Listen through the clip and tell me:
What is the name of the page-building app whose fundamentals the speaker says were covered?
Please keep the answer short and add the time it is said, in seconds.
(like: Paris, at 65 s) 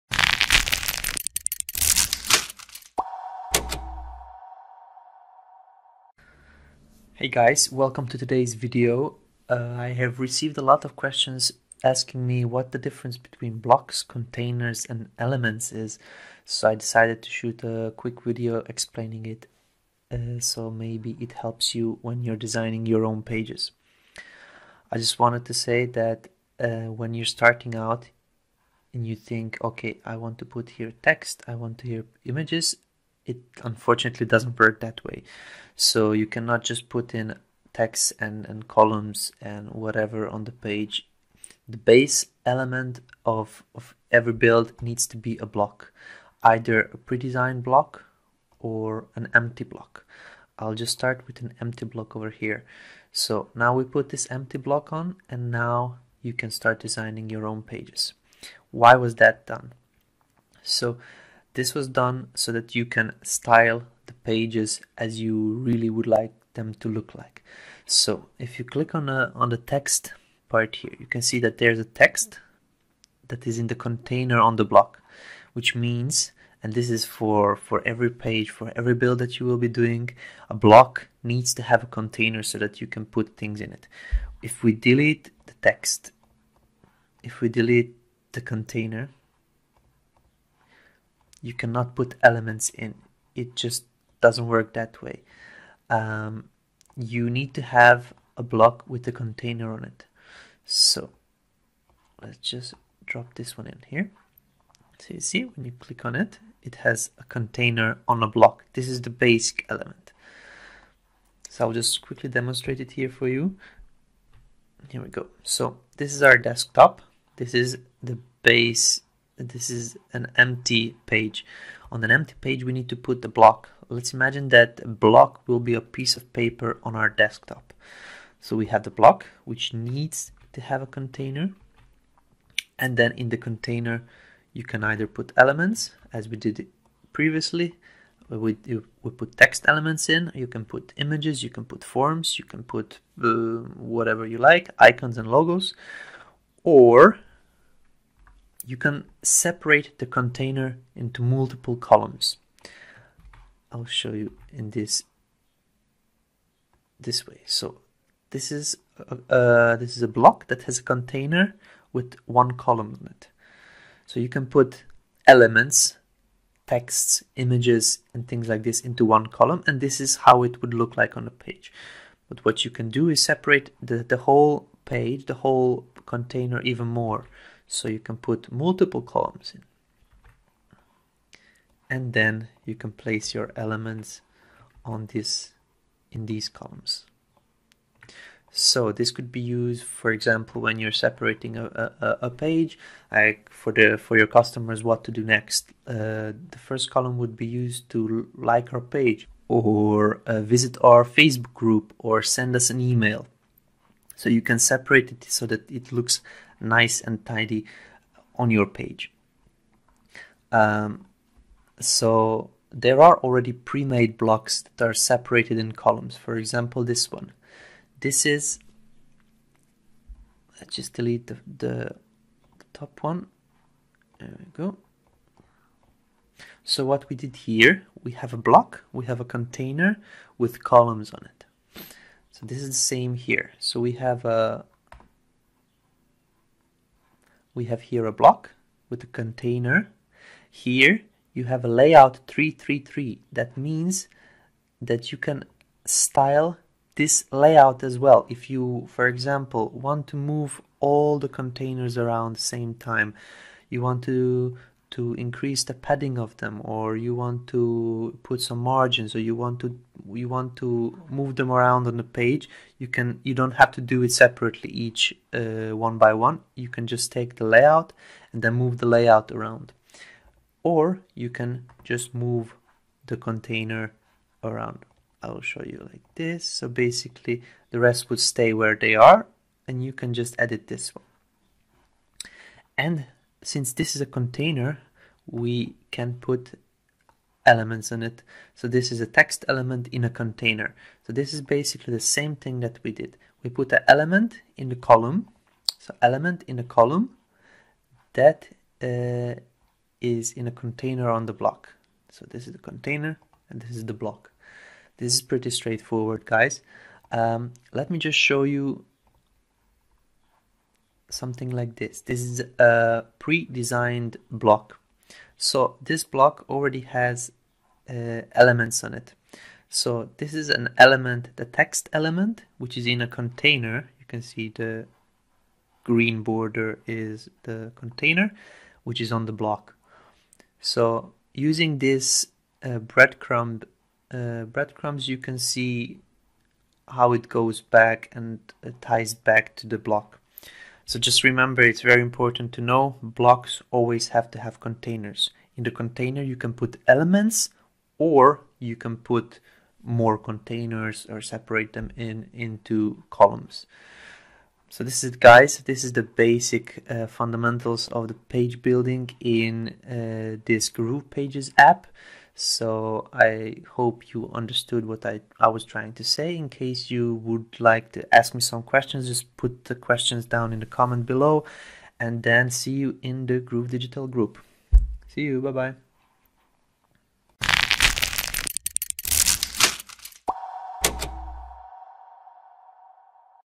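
Groove Pages, at 360 s.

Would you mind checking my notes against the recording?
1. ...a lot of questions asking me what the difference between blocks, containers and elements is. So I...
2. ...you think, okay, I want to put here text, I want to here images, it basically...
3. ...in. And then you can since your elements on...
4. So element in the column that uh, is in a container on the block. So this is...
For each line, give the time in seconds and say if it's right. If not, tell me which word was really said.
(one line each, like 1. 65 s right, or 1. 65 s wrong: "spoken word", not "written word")
1. 10 s right
2. 29 s wrong: "unfortunately", not "basically"
3. 179 s wrong: "place", not "since"
4. 295 s right.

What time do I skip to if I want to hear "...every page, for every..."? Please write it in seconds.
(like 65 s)
77 s.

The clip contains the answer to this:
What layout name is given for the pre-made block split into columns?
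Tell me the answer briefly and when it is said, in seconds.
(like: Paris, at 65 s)
Layout 333, at 241 s.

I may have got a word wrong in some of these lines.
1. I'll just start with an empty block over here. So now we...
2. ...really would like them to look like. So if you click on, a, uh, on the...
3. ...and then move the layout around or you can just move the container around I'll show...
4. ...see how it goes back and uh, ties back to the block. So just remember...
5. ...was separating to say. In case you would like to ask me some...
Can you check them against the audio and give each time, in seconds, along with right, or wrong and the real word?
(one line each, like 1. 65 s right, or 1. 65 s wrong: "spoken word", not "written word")
1. 50 s right
2. 65 s right
3. 268 s right
4. 335 s right
5. 365 s wrong: "trying", not "separating".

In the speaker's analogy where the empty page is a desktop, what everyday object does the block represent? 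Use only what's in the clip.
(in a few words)
A piece of paper.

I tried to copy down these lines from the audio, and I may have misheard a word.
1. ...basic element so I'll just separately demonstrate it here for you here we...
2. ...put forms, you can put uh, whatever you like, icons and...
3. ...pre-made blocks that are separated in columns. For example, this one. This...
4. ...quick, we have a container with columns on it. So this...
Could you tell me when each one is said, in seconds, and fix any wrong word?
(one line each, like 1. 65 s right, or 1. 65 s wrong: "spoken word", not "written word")
1. 109 s wrong: "quickly", not "separately"
2. 141 s right
3. 213 s right
4. 228 s wrong: "block", not "quick".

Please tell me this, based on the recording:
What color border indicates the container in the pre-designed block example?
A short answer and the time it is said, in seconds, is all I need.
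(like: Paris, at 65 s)
Green, at 325 s.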